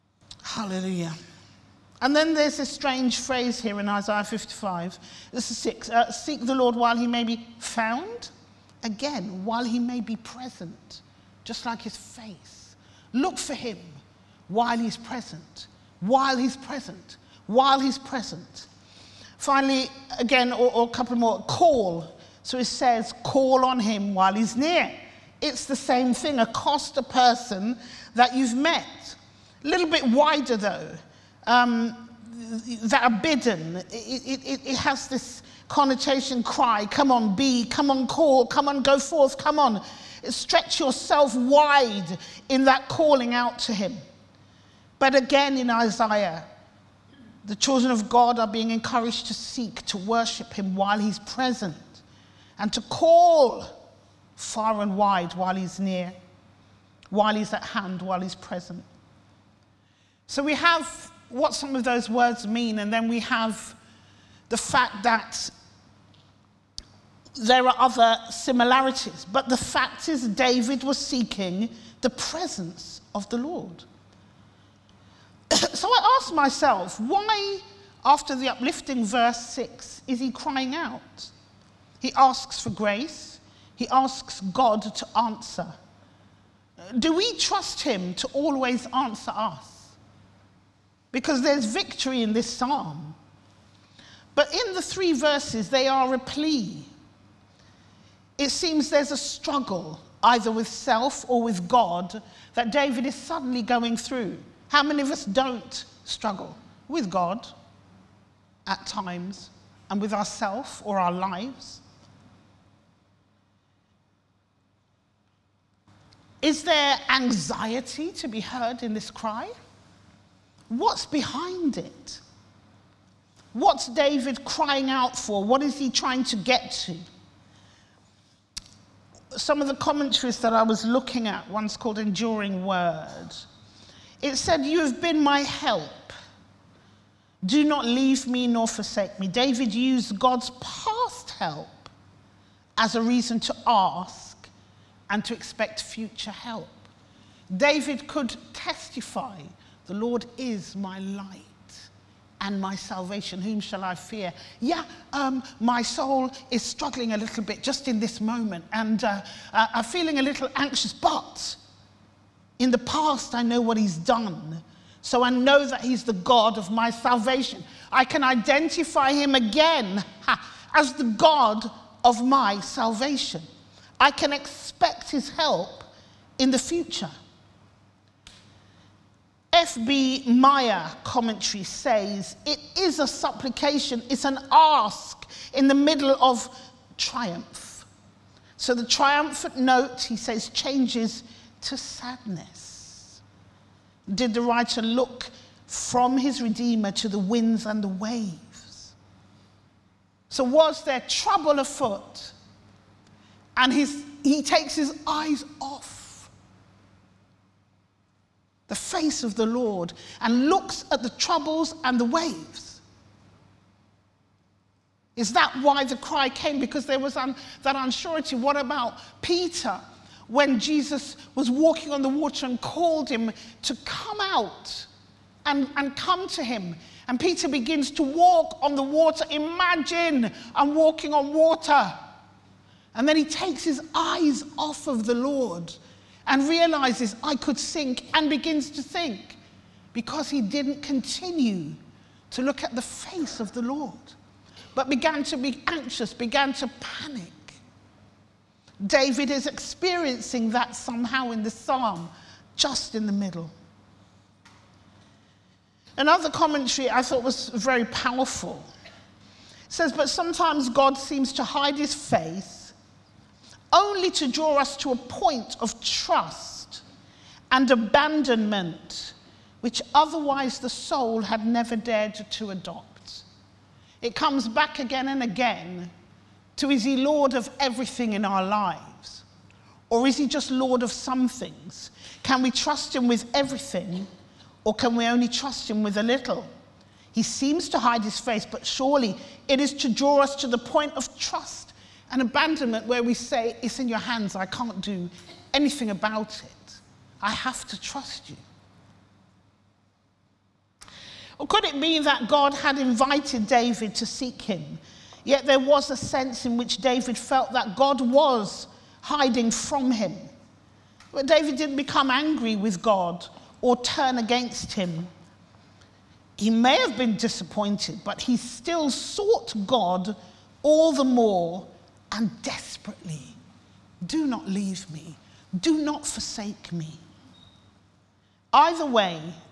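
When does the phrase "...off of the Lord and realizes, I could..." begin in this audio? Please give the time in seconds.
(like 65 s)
234 s.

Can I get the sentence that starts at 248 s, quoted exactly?
David is experiencing that somehow in the psalm, just in the middle.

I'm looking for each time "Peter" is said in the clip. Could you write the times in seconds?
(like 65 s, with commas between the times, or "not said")
219 s, 227 s.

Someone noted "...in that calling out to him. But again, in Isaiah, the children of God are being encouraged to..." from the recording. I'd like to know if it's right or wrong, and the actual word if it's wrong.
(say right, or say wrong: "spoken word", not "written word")
right.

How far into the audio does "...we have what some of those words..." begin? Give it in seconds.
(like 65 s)
60 s.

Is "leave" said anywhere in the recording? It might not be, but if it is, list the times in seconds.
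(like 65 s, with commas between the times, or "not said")
137 s, 324 s.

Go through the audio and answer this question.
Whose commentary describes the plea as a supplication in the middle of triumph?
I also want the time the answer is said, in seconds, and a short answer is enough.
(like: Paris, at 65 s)
F.B. Meyer, at 179 s.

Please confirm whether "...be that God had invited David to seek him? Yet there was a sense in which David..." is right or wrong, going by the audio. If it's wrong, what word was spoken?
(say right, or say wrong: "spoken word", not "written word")
right.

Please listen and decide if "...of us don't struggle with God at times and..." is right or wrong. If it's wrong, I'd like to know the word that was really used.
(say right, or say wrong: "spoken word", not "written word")
right.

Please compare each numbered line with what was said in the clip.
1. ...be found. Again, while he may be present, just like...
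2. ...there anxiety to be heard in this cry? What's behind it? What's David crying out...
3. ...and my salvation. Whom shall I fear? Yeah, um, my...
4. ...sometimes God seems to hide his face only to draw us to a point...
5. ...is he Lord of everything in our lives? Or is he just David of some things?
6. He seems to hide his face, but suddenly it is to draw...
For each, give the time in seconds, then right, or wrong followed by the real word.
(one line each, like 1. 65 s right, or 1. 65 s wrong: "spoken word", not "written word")
1. 7 s right
2. 116 s right
3. 152 s right
4. 260 s right
5. 276 s wrong: "Lord", not "David"
6. 287 s wrong: "surely", not "suddenly".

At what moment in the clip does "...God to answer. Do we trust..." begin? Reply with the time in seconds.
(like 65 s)
84 s.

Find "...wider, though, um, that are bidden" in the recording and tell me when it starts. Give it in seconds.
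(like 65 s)
30 s.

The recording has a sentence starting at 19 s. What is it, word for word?
Finally, again, or, or a couple more, call so it says, call on him while he's near.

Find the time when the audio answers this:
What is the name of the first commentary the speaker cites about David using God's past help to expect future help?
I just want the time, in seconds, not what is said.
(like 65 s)
131 s.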